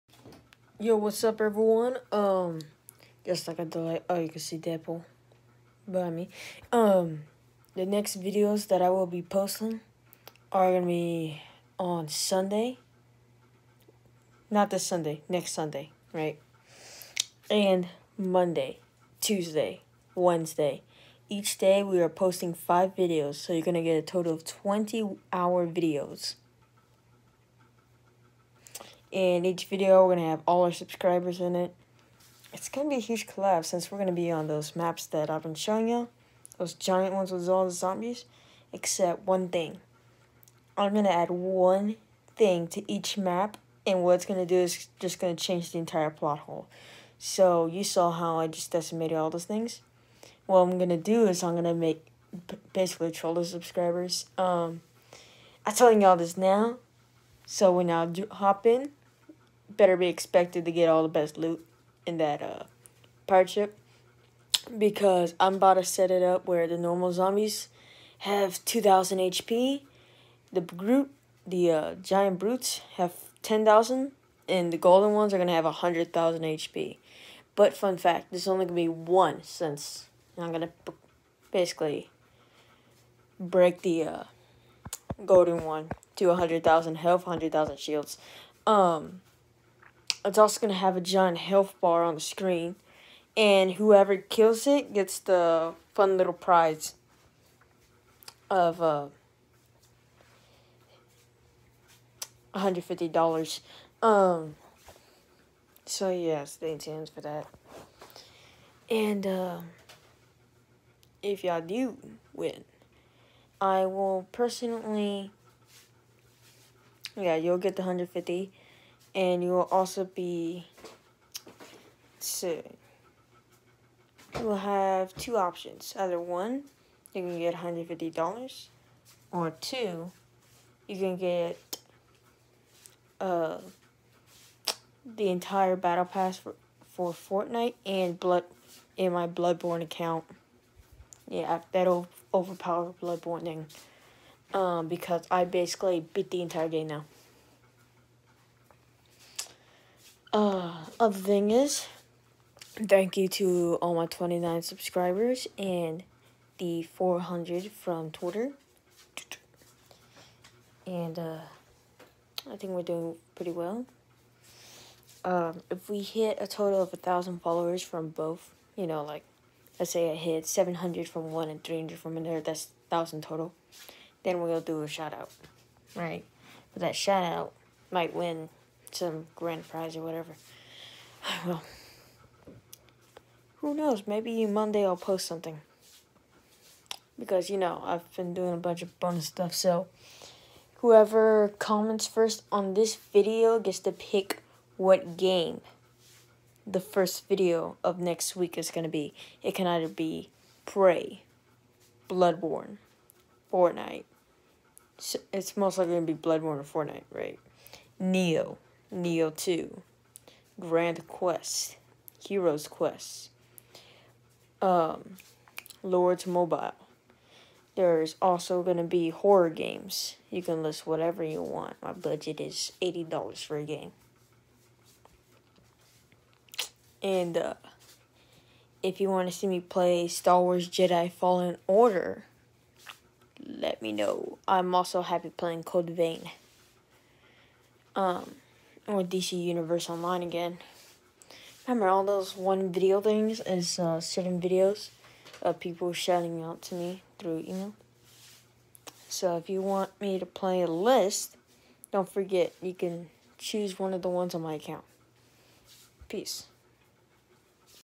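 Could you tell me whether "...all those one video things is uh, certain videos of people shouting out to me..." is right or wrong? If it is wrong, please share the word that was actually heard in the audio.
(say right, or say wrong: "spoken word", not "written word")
right.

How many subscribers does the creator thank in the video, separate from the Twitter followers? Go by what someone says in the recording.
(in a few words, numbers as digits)
29.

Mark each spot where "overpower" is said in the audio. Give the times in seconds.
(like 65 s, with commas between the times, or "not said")
142 s.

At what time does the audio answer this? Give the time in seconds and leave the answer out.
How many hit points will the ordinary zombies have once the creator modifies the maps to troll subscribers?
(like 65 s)
68 s.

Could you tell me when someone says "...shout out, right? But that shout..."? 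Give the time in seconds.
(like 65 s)
174 s.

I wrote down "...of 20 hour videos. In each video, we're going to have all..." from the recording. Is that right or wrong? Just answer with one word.
right.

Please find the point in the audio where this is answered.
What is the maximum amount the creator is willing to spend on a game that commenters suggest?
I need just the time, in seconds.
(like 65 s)
222 s.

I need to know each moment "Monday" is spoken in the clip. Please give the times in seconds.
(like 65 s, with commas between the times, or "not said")
18 s, 184 s.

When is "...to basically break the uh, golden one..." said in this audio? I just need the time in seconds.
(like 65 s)
80 s.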